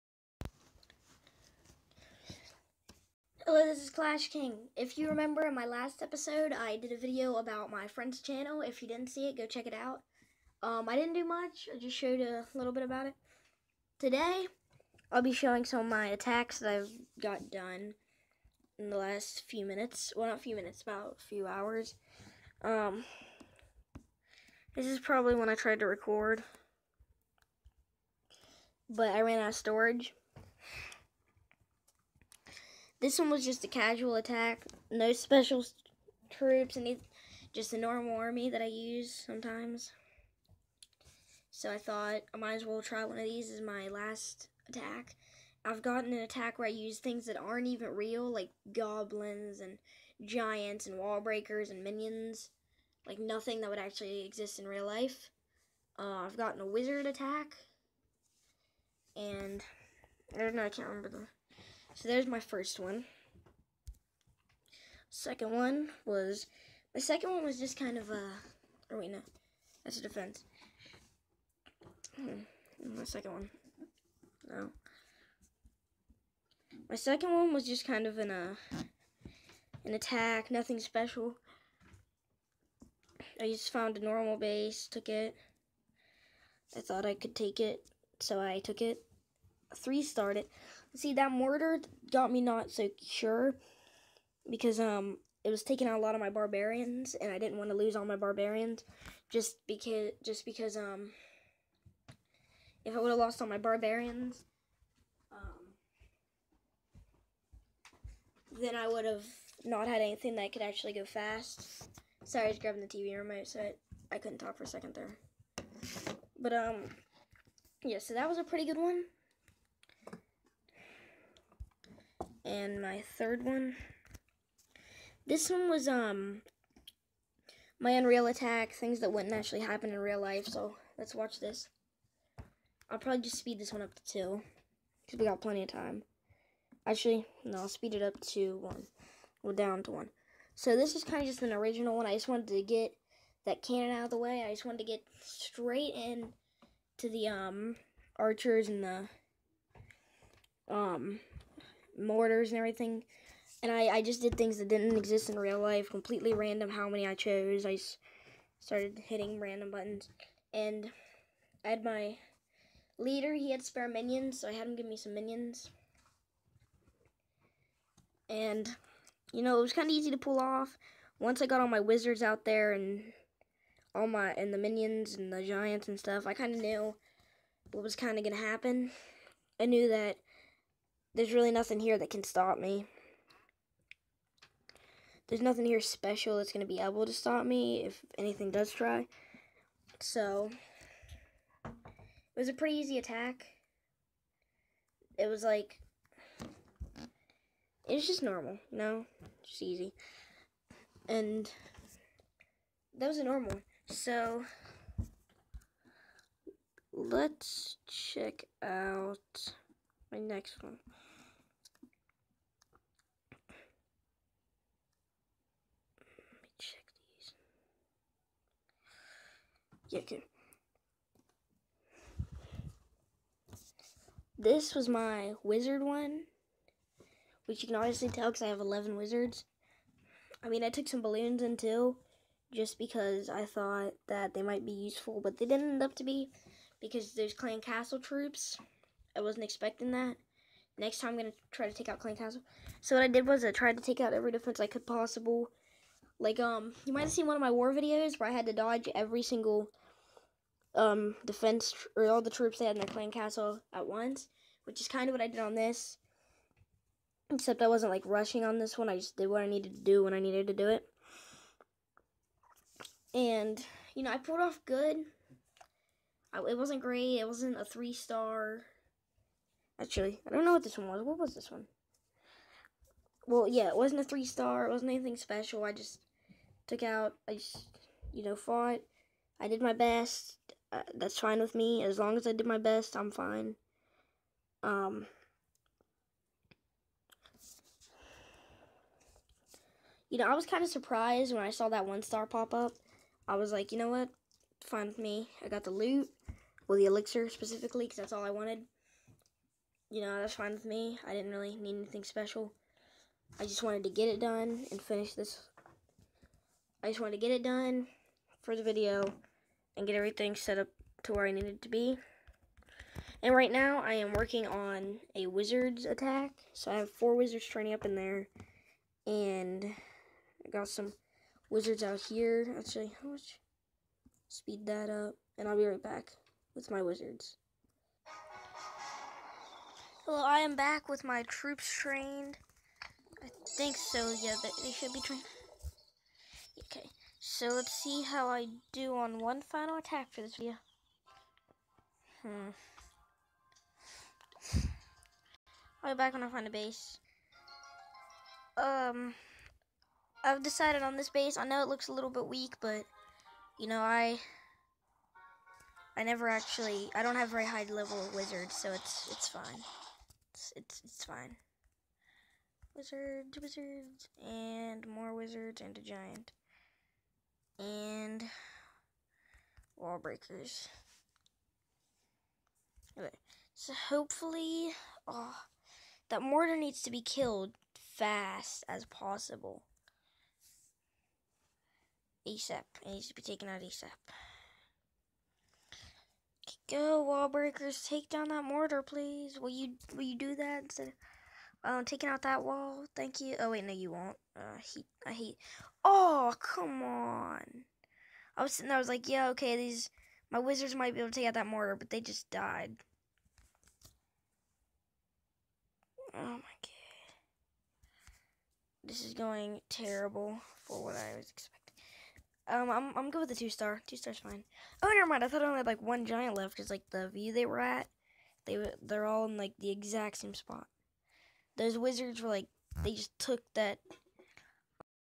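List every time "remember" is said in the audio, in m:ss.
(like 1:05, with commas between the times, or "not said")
0:05, 1:00.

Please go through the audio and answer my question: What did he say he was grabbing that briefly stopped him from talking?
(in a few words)
TV remote.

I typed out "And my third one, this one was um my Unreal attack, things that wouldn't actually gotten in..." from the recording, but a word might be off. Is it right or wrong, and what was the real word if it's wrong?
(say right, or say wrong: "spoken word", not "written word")
wrong: "happen", not "gotten".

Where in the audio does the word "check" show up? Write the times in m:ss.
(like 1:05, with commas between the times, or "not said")
0:09, 3:27.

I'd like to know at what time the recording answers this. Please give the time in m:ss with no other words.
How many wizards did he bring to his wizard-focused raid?
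3:48.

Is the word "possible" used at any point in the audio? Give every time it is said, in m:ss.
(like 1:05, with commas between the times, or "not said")
4:04, 6:18.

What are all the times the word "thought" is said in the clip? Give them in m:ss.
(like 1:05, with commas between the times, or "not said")
0:41, 1:26, 3:53, 6:55.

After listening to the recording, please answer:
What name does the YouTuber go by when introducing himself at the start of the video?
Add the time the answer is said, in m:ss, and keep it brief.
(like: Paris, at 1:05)
Clash King, at 0:03.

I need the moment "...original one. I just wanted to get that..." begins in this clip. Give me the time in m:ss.
2:21.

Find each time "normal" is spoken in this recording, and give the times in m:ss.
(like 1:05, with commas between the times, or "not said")
0:37, 1:24, 3:18, 3:23.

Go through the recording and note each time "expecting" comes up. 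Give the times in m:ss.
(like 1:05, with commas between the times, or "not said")
3:59, 6:51.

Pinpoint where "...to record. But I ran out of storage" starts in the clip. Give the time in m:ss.
0:25.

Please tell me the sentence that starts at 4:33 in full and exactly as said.
Well, yeah, it wasn't a three star.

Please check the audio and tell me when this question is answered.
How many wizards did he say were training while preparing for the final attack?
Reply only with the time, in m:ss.
5:16.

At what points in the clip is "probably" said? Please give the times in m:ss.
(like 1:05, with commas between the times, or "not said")
0:24, 2:12.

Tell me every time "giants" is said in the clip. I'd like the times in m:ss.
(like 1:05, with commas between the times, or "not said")
0:50, 2:55, 6:05, 6:56.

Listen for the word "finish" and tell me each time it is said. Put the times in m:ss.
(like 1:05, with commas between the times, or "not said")
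5:04.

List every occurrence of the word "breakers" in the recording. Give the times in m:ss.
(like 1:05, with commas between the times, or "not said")
0:51, 6:09, 6:27.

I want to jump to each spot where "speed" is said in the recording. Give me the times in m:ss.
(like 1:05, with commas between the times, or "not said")
2:13, 2:17, 5:24.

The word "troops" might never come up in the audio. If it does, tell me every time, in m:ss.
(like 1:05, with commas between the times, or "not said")
0:36, 3:57, 4:12, 5:31.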